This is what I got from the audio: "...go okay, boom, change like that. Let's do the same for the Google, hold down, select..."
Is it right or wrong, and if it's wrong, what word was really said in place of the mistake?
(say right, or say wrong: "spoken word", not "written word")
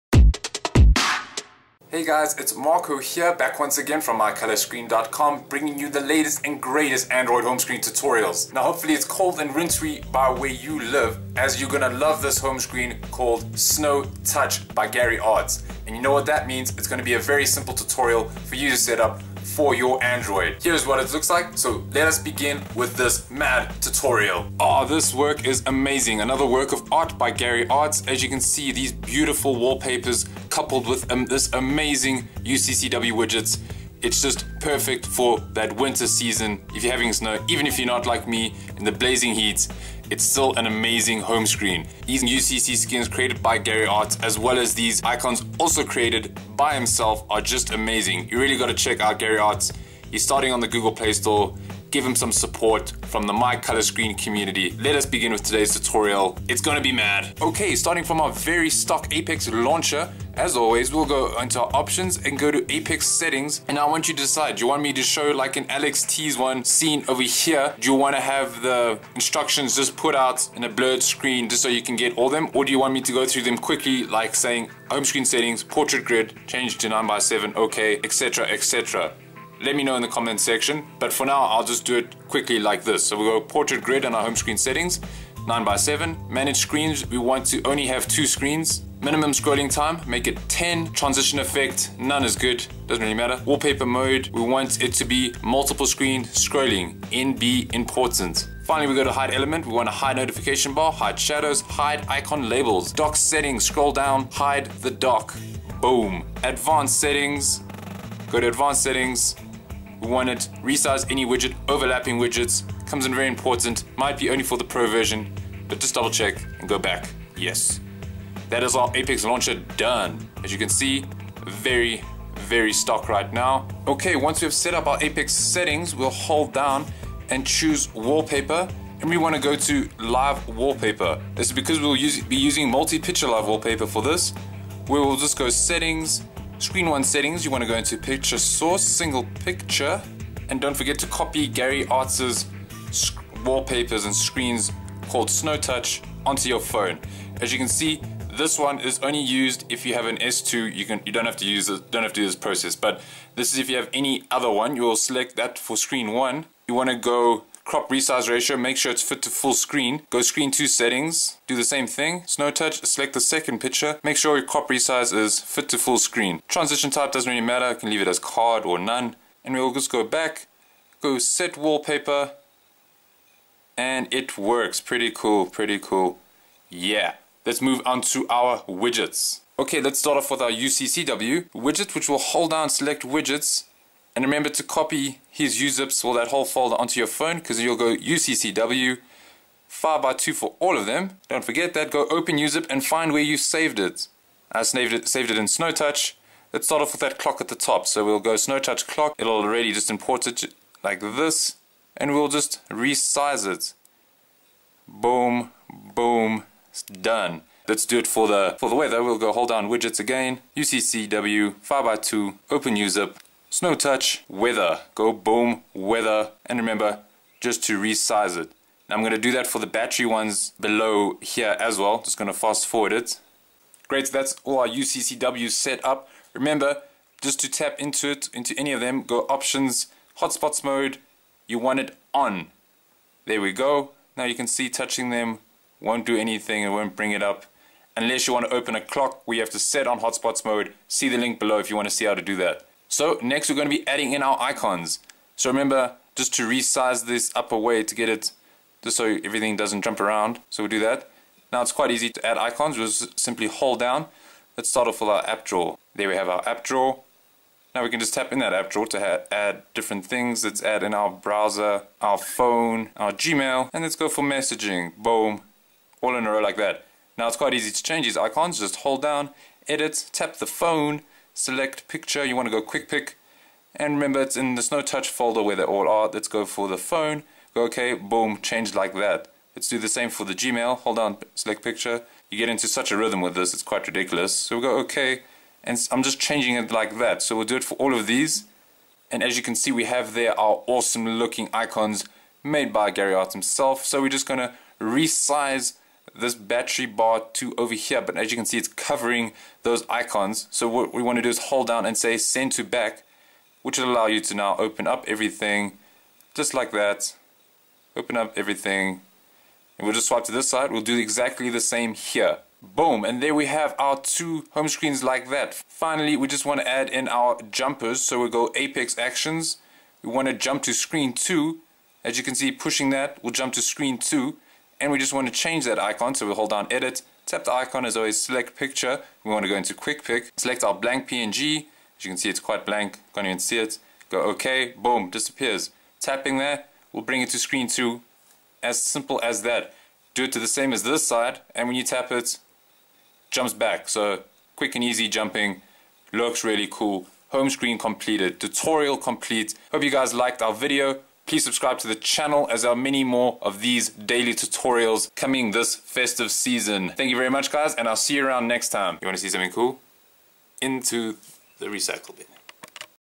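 wrong: "Gmail", not "Google".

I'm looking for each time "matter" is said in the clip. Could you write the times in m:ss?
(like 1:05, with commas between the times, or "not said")
1:33, 2:47.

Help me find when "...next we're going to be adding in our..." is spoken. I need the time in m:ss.
4:03.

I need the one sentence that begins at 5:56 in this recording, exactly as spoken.
Thank you very much guys and I'll see you around next time.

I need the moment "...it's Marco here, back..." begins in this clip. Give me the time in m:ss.
0:02.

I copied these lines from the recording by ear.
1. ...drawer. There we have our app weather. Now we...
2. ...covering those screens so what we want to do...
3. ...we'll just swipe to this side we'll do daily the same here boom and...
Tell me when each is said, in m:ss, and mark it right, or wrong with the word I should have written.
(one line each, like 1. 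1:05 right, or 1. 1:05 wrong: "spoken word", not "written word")
1. 4:15 wrong: "drawer", not "weather"
2. 4:58 wrong: "icons", not "screens"
3. 5:09 wrong: "exactly", not "daily".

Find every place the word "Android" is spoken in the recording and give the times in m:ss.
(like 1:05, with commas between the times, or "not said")
0:07, 0:20.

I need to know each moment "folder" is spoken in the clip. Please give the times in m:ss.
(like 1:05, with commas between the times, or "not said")
3:06, 4:35.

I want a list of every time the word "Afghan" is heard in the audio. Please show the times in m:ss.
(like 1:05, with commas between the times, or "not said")
not said.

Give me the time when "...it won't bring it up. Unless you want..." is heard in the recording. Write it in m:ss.
3:56.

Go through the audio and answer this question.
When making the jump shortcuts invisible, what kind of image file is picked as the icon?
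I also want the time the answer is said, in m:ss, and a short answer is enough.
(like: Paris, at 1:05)
blank png, at 5:30.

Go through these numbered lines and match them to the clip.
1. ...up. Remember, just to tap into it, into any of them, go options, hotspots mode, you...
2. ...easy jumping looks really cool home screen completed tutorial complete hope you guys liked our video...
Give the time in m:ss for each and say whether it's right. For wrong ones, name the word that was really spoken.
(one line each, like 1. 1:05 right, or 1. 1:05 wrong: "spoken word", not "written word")
1. 3:45 right
2. 5:44 right.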